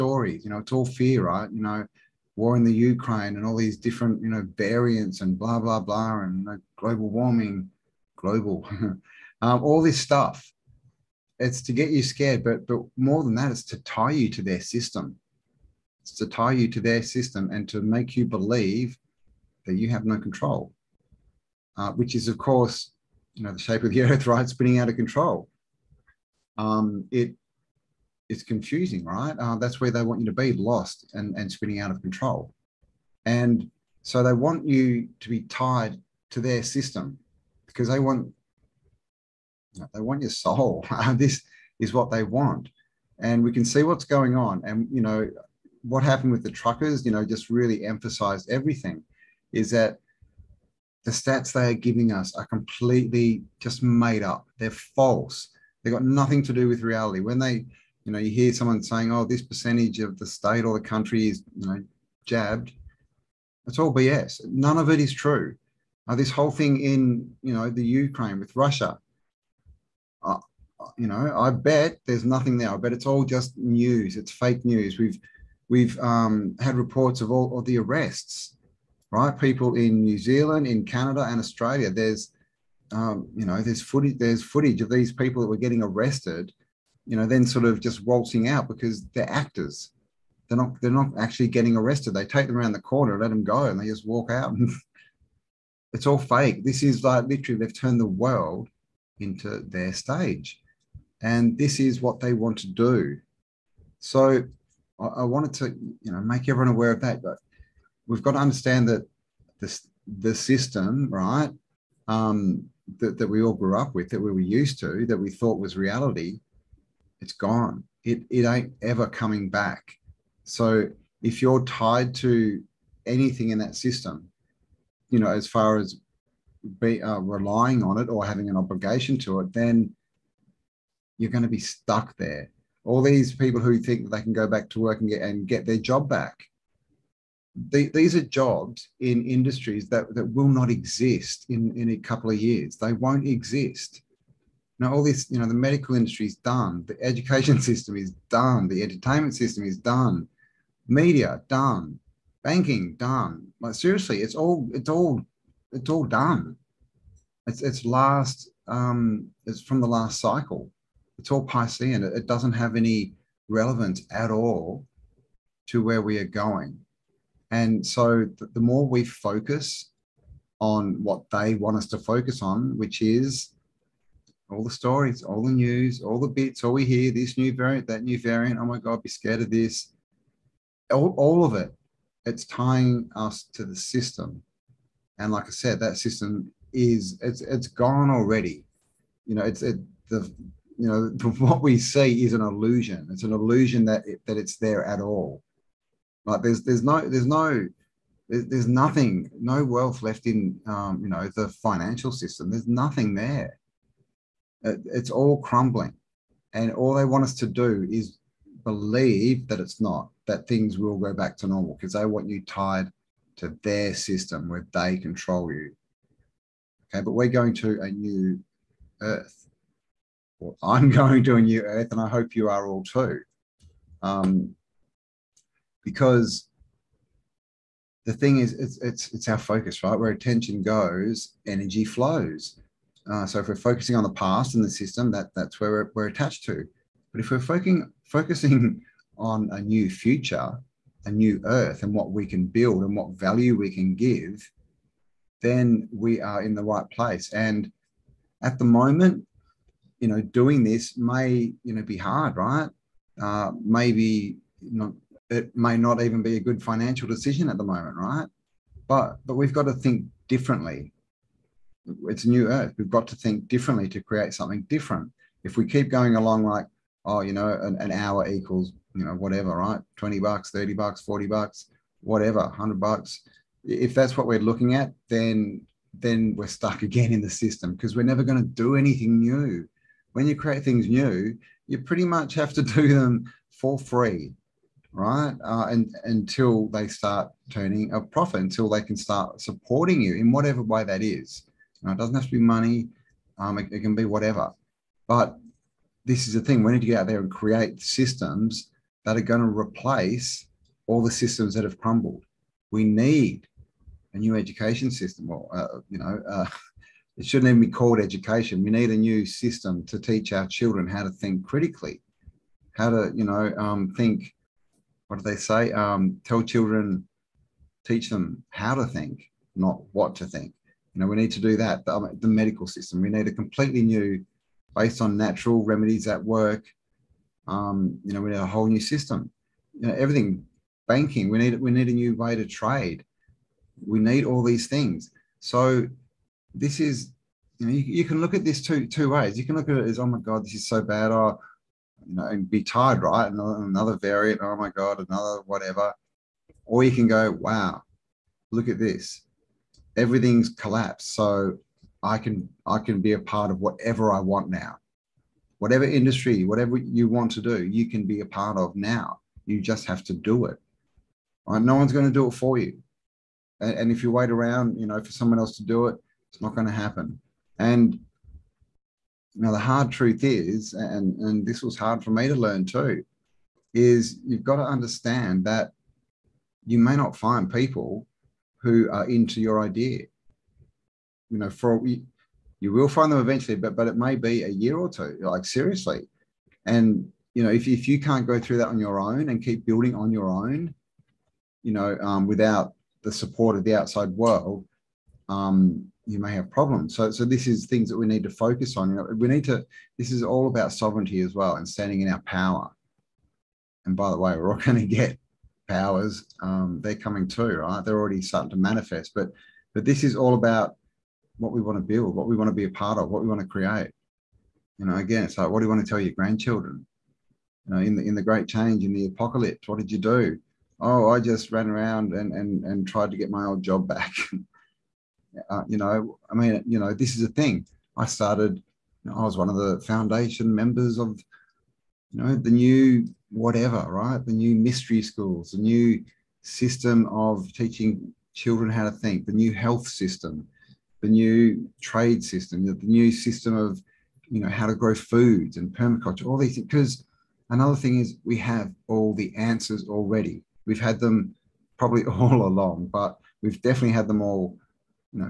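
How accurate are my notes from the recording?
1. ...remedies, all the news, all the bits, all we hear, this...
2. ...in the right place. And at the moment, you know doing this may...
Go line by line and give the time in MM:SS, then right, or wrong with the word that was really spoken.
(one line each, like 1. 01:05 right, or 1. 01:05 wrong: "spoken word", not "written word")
1. 02:54 wrong: "stories", not "remedies"
2. 04:06 right.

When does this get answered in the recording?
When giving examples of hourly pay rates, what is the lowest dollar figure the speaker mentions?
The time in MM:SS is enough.
04:29.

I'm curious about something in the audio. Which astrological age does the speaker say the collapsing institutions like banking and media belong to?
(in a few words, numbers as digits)
Piscean.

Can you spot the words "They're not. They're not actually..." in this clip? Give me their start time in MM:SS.
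01:30.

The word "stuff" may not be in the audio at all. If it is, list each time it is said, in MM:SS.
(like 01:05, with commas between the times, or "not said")
00:09.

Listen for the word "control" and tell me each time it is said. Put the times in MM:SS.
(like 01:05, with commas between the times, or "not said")
00:20, 00:24, 00:32, 03:34.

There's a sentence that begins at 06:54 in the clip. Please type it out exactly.
You know, again, it's like, what do you want to tell your grandchildren?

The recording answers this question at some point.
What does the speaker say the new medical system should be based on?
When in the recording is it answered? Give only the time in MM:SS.
05:25.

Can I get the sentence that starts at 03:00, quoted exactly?
All, all of it, it's tying us to the system.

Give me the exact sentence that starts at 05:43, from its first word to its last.
Another, another variant, oh my god, another whatever.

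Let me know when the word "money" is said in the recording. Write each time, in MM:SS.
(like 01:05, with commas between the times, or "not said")
04:52.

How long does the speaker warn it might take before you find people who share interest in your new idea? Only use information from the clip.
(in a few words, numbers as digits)
a year or two.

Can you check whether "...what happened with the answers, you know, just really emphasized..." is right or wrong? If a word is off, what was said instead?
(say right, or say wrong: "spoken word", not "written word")
wrong: "truckers", not "answers".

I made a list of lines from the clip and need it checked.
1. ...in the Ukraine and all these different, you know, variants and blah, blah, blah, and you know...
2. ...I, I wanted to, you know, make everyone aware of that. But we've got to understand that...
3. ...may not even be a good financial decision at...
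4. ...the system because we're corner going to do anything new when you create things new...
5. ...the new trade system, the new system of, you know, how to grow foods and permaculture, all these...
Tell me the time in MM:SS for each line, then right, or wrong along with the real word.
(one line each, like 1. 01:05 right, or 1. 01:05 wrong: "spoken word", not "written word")
1. 00:02 right
2. 01:44 right
3. 04:15 right
4. 04:37 wrong: "never", not "corner"
5. 07:21 right.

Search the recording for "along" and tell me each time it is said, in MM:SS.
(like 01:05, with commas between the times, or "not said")
04:26, 07:32.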